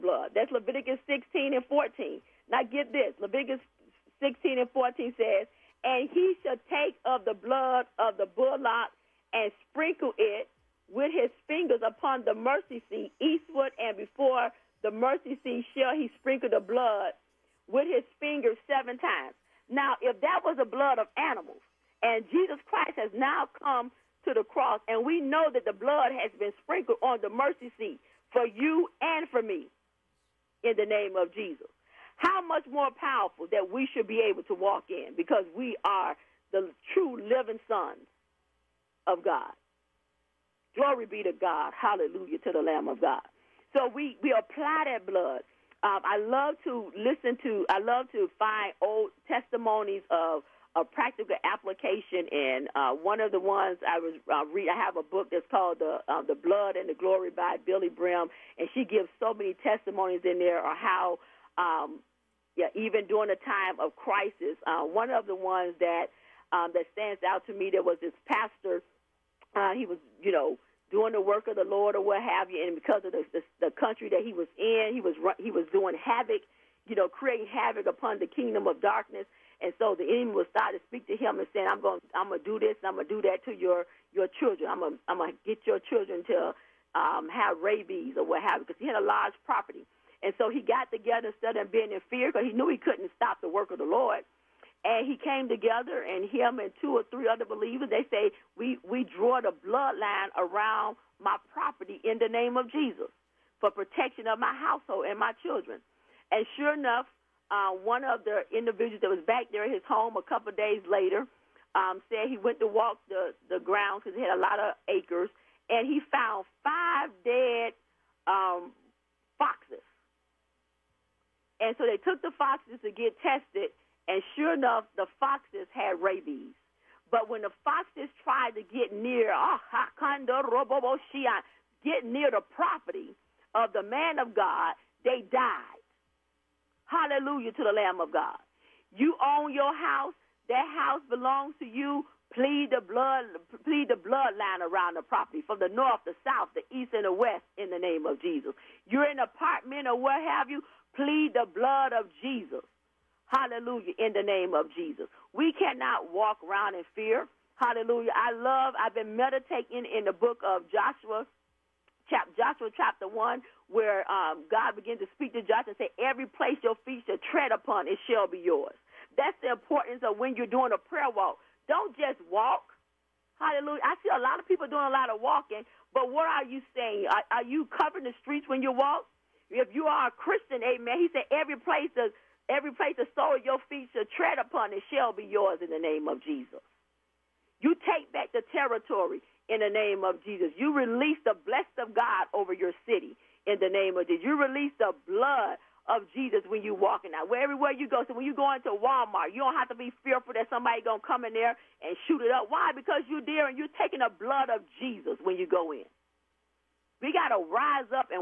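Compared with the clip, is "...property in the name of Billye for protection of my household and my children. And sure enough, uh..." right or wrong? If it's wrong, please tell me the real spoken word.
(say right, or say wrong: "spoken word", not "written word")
wrong: "Jesus", not "Billye".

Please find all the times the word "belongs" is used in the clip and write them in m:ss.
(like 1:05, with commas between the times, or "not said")
2:21.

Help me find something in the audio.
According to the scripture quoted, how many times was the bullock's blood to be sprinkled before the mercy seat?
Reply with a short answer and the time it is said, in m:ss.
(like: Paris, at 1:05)
7, at 0:18.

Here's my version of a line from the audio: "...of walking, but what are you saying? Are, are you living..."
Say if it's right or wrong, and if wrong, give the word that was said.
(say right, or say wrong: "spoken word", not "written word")
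wrong: "covering", not "living".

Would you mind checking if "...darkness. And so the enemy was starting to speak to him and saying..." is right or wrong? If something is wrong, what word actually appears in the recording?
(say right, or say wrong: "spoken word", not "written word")
right.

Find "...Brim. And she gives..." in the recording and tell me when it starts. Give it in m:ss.
0:57.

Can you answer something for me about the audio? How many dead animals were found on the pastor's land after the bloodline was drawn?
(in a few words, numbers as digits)
5.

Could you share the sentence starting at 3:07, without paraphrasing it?
You take back the territory in the name of Jesus.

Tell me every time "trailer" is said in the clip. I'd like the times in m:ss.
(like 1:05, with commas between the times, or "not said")
not said.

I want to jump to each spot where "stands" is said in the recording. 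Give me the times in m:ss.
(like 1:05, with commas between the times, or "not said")
1:06.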